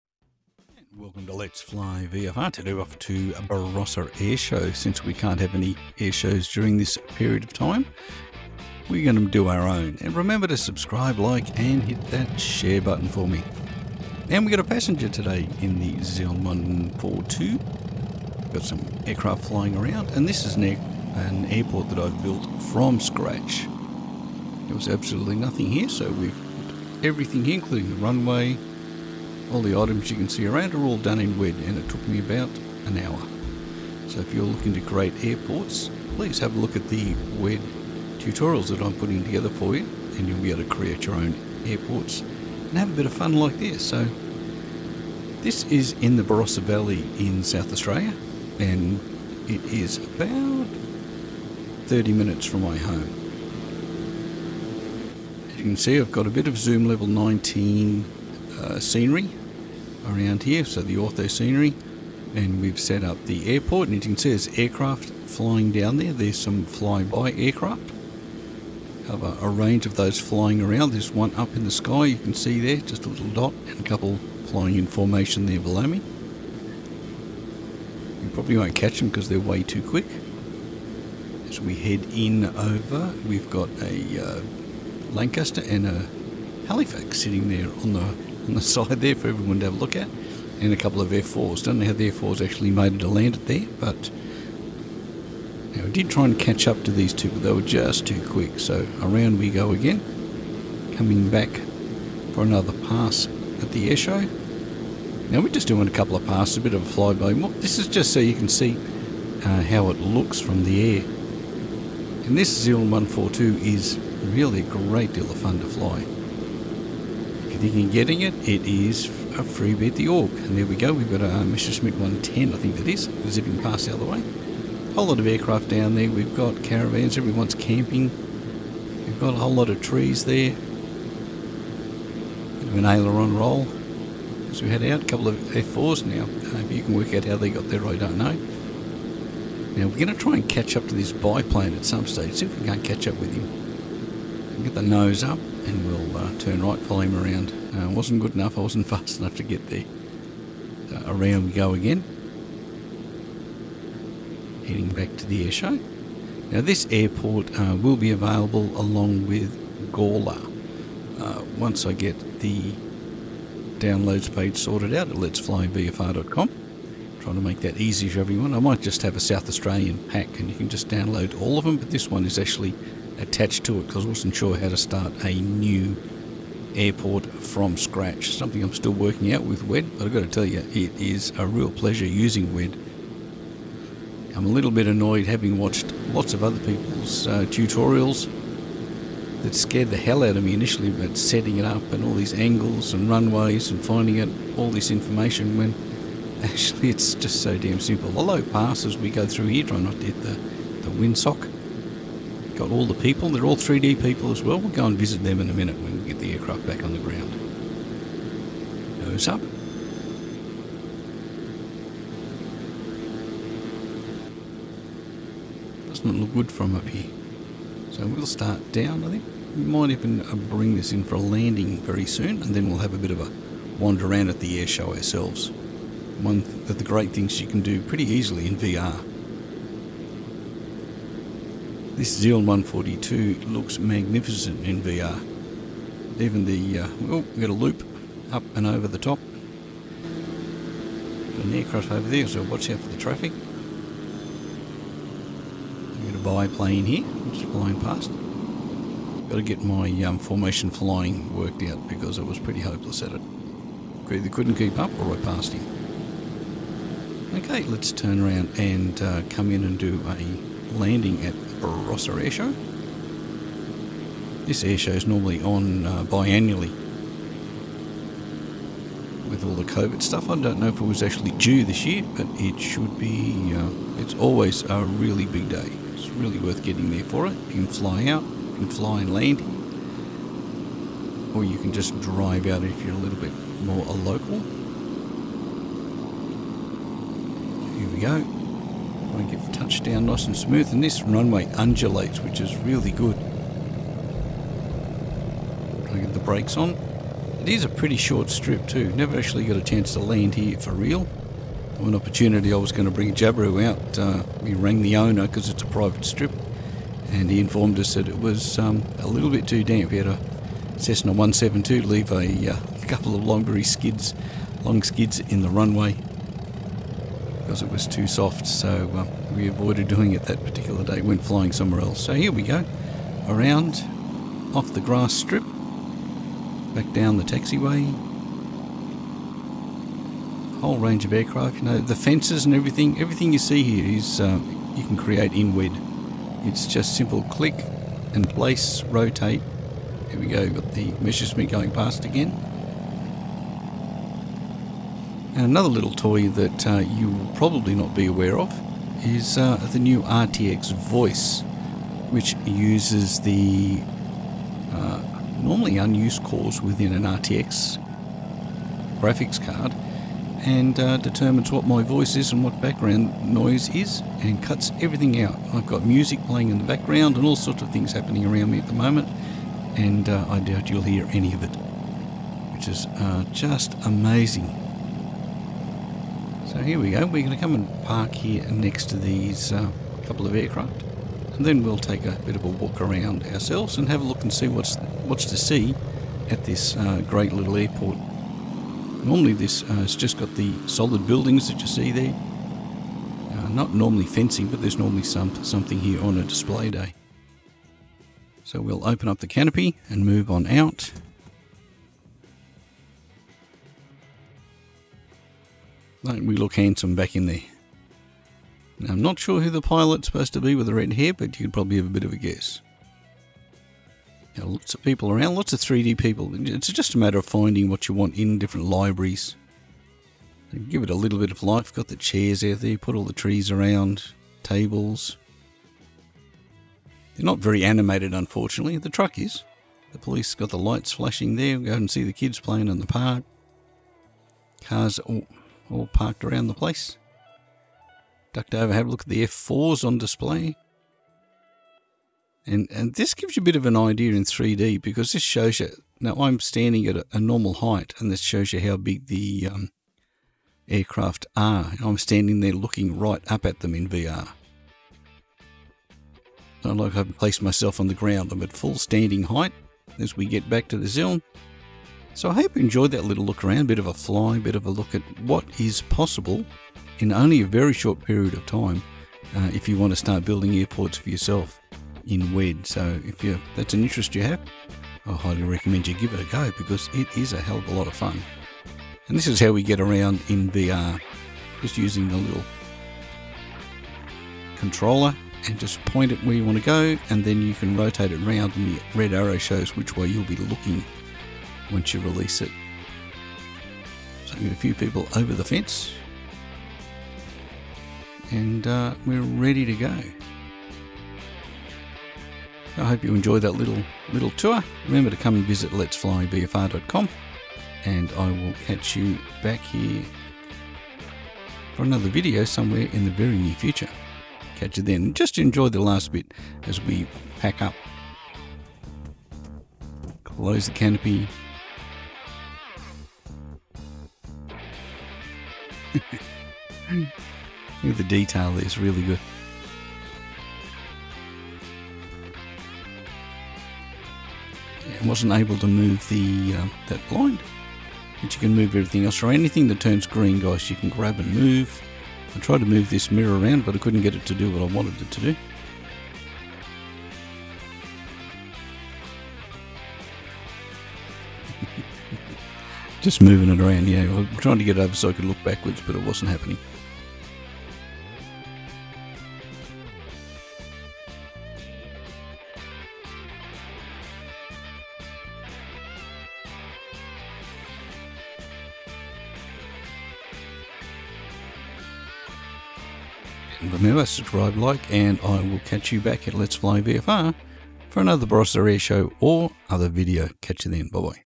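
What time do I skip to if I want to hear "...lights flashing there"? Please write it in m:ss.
7:10.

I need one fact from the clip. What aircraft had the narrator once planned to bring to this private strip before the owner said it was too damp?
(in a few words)
Jabiru.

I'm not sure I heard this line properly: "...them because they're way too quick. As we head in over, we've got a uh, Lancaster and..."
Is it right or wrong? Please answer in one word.
right.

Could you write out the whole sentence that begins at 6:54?
Now, lots of people around, lots of 3D people.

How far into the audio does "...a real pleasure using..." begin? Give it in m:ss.
3:01.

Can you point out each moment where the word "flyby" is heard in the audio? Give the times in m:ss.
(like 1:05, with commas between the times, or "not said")
1:06, 1:47.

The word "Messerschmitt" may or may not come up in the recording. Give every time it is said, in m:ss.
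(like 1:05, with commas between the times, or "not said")
2:01, 5:41.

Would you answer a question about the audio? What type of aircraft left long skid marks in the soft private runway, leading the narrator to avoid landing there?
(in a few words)
Cessna 172.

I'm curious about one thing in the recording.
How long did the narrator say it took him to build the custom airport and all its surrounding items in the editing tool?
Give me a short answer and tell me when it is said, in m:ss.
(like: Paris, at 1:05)
About an hour, at 0:32.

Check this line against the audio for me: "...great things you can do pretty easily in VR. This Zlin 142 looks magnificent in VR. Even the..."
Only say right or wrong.
right.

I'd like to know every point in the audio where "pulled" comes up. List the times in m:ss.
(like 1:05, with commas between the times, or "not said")
not said.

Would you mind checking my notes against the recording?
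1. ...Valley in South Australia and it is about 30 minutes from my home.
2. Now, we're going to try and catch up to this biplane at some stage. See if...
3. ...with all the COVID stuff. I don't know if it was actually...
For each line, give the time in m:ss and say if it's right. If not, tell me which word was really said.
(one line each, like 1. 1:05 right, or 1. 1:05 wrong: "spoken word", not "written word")
1. 0:46 right
2. 2:19 right
3. 4:29 right.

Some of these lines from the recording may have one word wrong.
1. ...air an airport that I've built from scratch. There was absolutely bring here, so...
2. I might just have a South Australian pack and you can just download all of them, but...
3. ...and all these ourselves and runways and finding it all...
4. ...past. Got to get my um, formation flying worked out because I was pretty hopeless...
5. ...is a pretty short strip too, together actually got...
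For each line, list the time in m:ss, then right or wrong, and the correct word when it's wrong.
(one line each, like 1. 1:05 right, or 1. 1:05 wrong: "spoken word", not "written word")
1. 0:20 wrong: "nothing", not "bring"
2. 2:48 right
3. 3:11 wrong: "angles", not "ourselves"
4. 4:07 right
5. 4:57 wrong: "never", not "together".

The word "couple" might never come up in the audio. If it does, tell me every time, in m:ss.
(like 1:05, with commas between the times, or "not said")
1:13, 1:30, 1:45, 2:15, 5:12, 6:20.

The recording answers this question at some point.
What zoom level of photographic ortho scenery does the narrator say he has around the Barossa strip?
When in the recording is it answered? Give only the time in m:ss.
0:56.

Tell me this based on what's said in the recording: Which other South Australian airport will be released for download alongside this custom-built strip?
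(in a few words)
Gawler.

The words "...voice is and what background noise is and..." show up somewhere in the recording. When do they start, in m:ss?
6:01.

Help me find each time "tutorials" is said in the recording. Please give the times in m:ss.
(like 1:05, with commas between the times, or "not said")
0:38, 3:07.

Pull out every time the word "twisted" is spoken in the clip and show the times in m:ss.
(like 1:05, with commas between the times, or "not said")
not said.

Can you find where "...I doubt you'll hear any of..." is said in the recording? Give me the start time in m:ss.
6:10.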